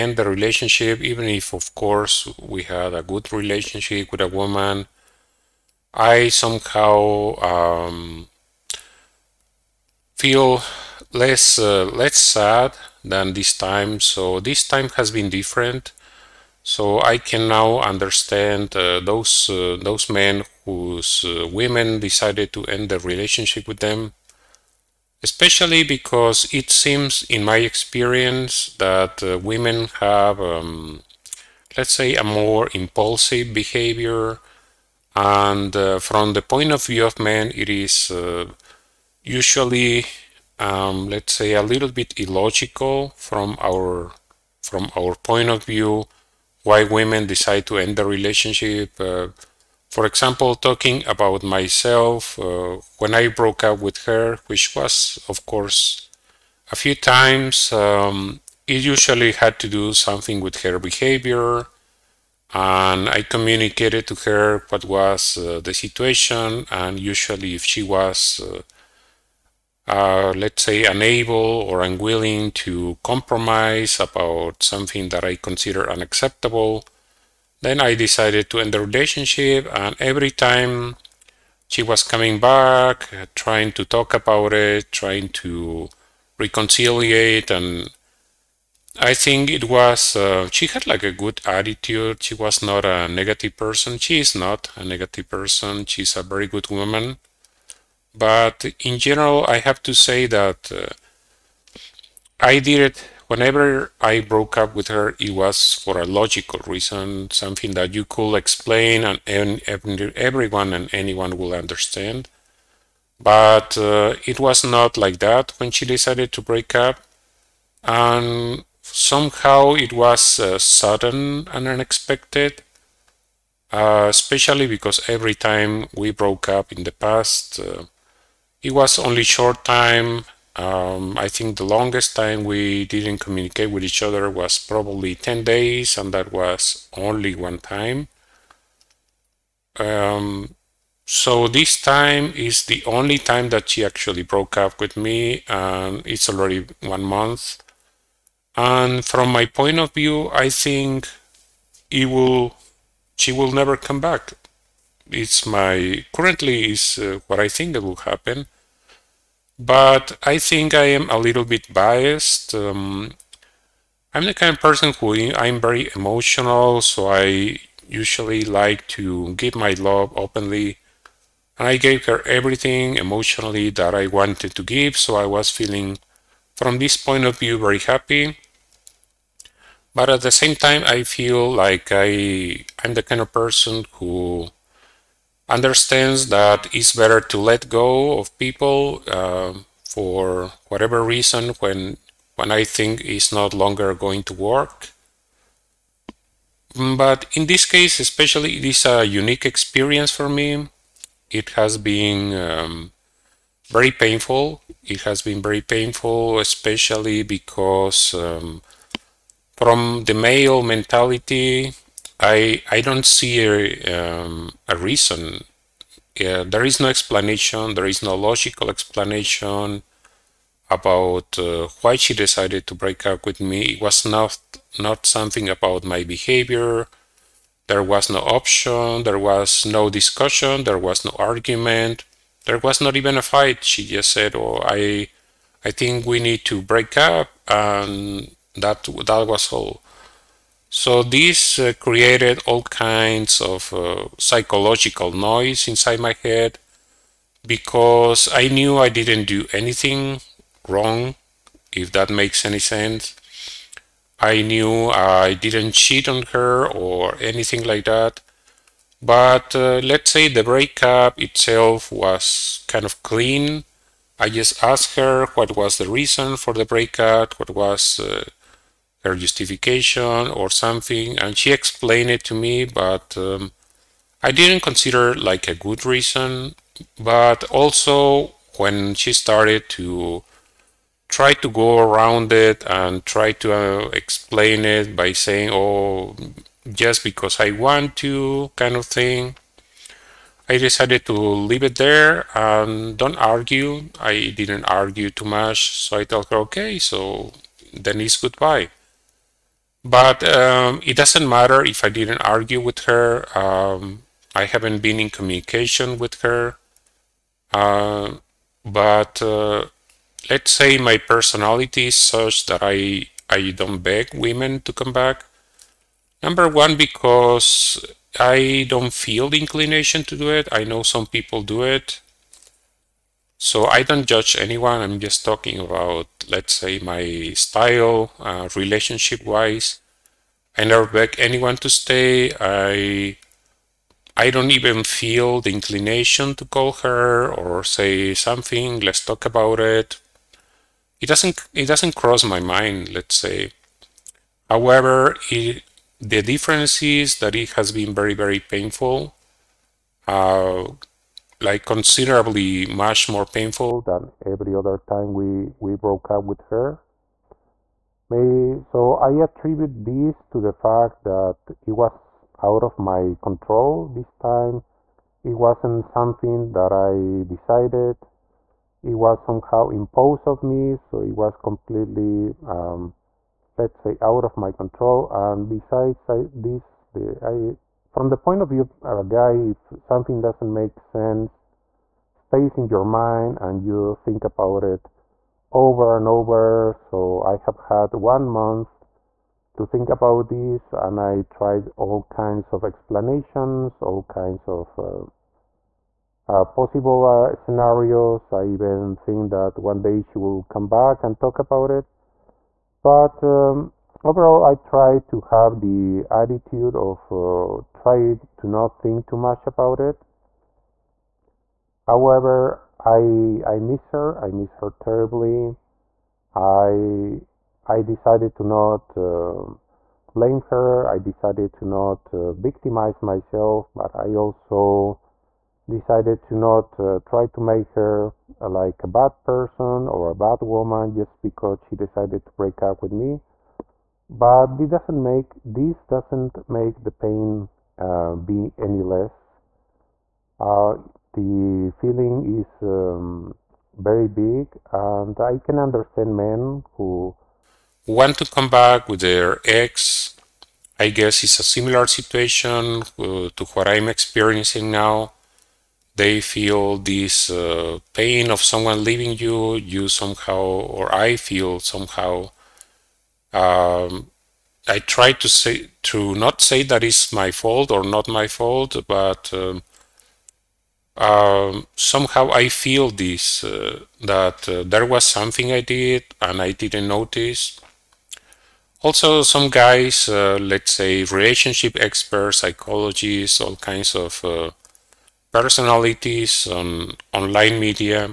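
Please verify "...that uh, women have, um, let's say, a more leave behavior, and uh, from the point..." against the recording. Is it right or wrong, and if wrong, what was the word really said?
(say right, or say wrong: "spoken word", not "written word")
wrong: "impulsive", not "leave".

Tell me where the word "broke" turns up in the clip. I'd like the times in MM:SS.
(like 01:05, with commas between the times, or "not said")
00:53, 01:44, 02:06, 02:24, 05:55.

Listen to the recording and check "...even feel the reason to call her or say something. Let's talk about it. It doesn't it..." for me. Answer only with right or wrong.
wrong.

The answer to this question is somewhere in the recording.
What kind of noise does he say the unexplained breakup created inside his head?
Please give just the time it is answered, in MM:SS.
04:04.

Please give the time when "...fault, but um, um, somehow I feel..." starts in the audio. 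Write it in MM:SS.
07:48.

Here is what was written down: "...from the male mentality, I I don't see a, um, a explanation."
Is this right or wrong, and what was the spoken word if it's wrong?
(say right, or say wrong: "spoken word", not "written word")
wrong: "reason", not "explanation".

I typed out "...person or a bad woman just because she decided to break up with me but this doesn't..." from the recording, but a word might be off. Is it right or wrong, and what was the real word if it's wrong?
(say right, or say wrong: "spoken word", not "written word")
right.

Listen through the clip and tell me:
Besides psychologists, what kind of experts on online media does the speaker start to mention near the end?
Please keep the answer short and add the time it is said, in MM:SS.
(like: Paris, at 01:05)
relationship experts, at 08:01.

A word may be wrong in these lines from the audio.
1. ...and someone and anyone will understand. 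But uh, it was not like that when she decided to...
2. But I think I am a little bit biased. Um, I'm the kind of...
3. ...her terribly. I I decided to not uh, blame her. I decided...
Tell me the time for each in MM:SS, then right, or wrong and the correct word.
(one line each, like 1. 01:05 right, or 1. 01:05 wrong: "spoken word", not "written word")
1. 01:49 wrong: "everyone", not "someone"
2. 02:39 right
3. 06:54 right.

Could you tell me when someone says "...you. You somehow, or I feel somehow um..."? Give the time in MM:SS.
07:39.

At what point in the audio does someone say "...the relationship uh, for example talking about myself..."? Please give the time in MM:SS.
00:47.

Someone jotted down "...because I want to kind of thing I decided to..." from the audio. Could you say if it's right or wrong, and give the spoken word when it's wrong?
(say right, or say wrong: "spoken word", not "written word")
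right.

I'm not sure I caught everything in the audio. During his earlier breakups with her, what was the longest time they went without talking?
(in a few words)
10 days.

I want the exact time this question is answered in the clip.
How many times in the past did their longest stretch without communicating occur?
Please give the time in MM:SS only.
02:17.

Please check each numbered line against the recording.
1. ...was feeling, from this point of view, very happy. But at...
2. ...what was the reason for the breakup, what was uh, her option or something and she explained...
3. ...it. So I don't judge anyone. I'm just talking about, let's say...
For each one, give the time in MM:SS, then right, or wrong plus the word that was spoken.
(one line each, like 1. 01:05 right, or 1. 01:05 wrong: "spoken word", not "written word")
1. 02:55 right
2. 04:25 wrong: "justification", not "option"
3. 05:21 right.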